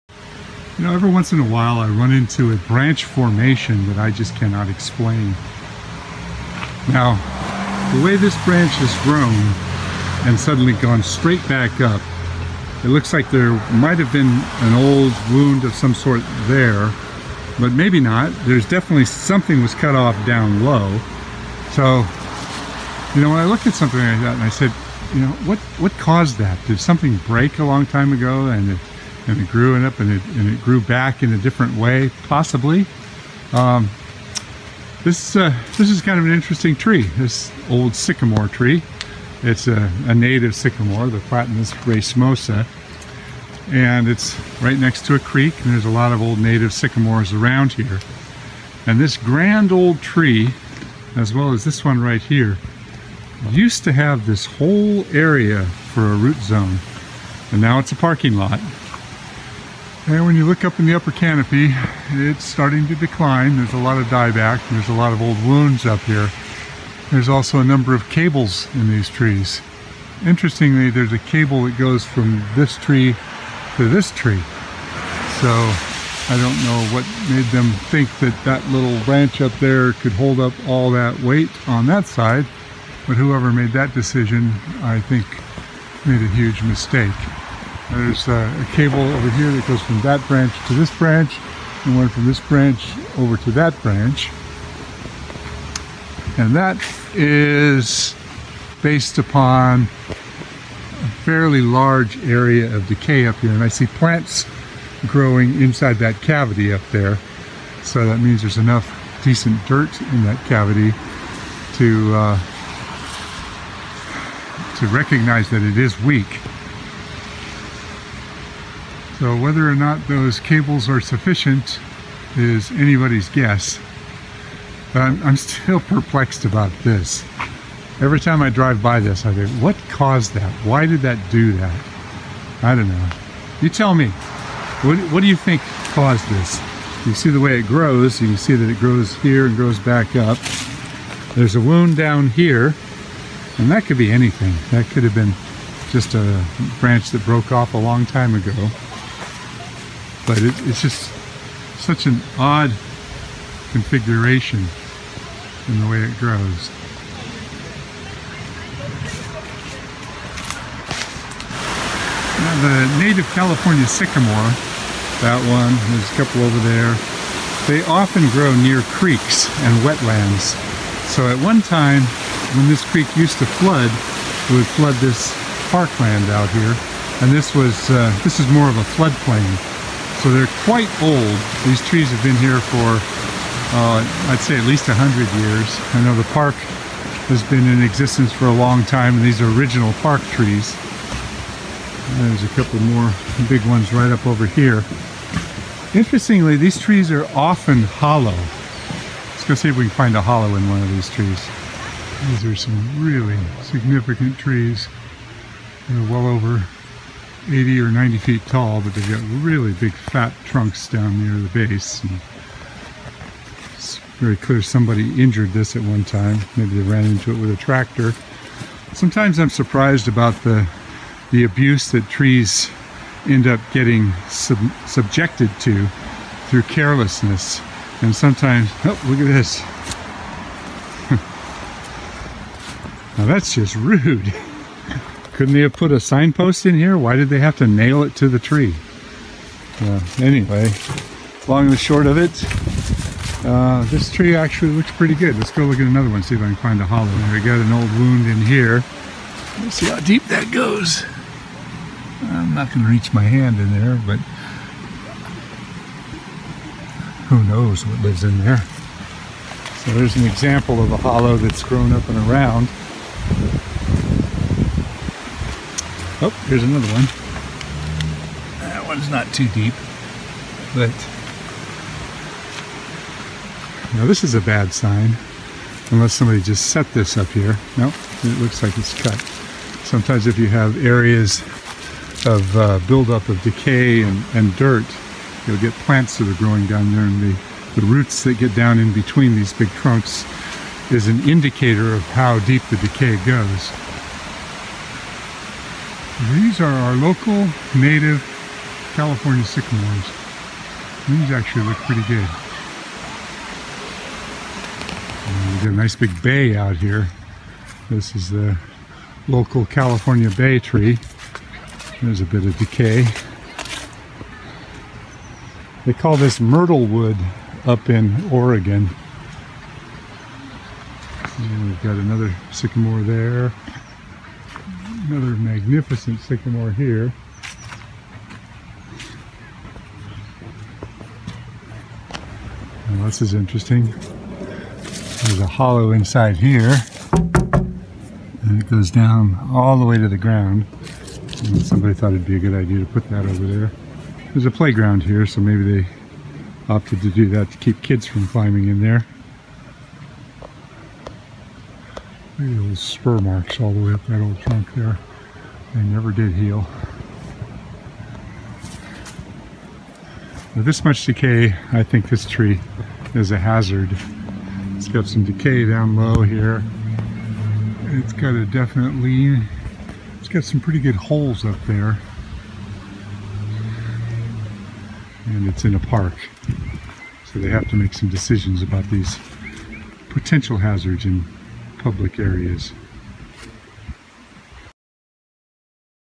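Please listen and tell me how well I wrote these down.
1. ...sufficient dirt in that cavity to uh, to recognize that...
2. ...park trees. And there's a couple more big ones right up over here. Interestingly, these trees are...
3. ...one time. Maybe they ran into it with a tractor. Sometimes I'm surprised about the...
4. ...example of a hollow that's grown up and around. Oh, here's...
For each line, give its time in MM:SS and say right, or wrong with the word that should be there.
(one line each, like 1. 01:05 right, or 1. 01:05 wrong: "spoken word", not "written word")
1. 01:49 wrong: "decent", not "sufficient"
2. 03:09 right
3. 03:35 right
4. 04:20 right.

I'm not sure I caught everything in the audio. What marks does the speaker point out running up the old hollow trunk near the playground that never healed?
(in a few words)
Spur marks.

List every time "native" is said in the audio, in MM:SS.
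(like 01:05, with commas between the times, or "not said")
00:40, 00:46, 02:43, 04:57.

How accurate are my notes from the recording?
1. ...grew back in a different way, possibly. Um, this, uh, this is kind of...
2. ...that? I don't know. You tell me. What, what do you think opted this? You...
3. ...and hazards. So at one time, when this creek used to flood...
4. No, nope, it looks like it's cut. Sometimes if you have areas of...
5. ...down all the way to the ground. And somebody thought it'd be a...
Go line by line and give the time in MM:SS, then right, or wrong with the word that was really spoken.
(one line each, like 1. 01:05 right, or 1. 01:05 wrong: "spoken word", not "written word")
1. 00:30 right
2. 02:11 wrong: "caused", not "opted"
3. 02:49 wrong: "wetlands", not "hazards"
4. 04:37 right
5. 05:38 right.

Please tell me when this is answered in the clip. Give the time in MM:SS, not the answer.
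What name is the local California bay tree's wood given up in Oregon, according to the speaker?
05:16.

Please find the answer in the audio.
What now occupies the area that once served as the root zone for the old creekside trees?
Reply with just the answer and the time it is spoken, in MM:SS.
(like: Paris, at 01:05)
A parking lot, at 00:57.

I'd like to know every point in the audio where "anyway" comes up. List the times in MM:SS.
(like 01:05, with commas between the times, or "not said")
04:00.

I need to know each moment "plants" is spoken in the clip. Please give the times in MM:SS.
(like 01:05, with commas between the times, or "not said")
01:43, 04:45.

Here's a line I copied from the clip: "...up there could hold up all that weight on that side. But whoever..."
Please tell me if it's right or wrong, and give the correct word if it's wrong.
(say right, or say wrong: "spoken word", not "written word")
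right.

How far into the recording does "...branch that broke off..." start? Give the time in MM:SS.
02:26.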